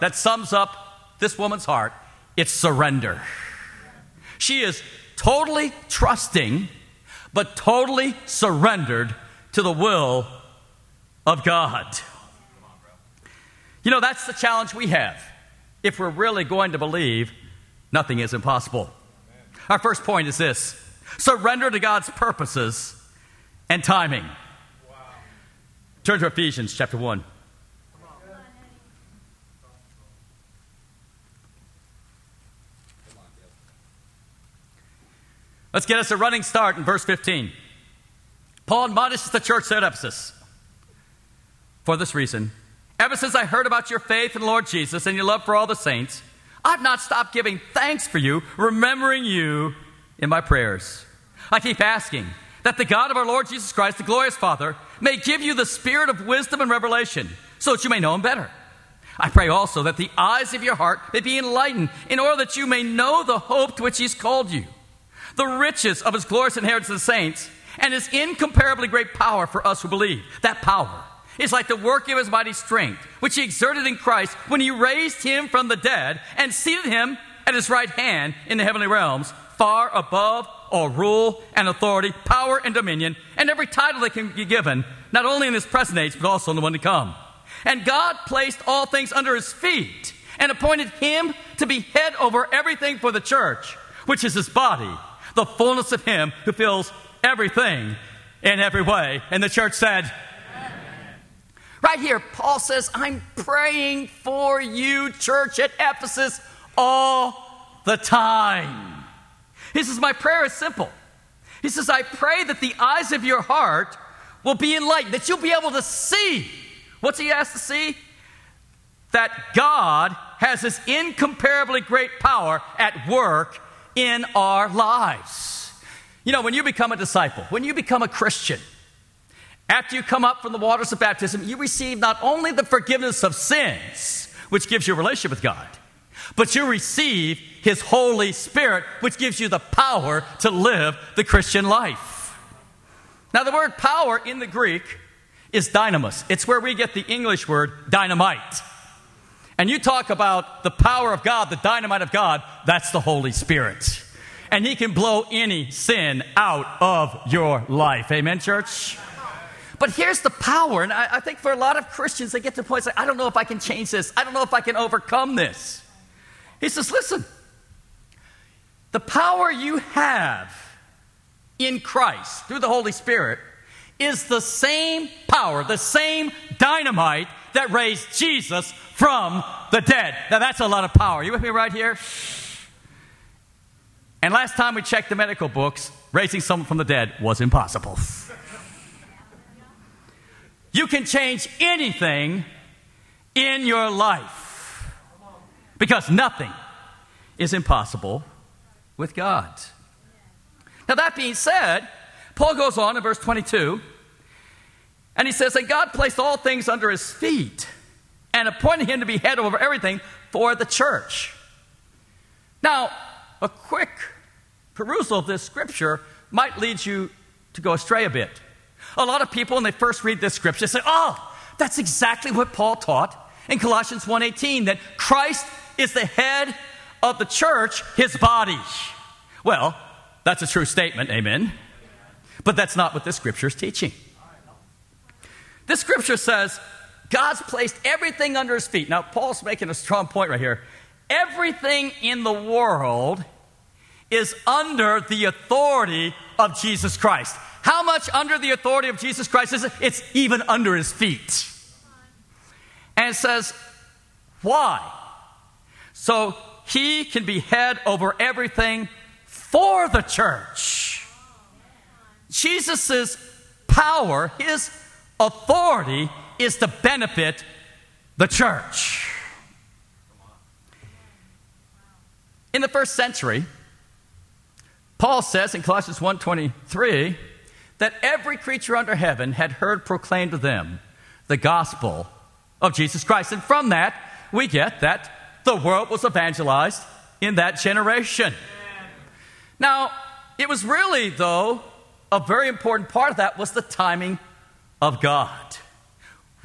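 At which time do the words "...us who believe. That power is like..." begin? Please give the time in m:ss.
1:09.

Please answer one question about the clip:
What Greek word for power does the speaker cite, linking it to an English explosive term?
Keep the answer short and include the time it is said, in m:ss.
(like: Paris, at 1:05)
dynamis, at 2:25.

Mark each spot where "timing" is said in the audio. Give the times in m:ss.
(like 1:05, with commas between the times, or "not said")
0:23, 4:53.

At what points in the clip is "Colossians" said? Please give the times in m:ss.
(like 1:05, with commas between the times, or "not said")
3:43, 4:35.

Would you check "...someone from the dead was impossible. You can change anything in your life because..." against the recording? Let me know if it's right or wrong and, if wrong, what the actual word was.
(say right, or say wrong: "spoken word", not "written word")
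right.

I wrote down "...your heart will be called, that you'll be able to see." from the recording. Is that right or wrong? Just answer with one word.
wrong.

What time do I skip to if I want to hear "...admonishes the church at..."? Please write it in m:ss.
0:38.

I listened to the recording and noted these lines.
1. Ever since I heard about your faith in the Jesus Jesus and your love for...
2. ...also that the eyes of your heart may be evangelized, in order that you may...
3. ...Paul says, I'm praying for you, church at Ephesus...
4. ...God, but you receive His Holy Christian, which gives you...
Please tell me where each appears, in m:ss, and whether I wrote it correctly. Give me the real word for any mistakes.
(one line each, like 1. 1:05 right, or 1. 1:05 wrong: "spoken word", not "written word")
1. 0:42 wrong: "Lord", not "Jesus"
2. 0:59 wrong: "enlightened", not "evangelized"
3. 1:42 right
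4. 2:15 wrong: "Spirit", not "Christian".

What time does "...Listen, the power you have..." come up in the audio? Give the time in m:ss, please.
2:46.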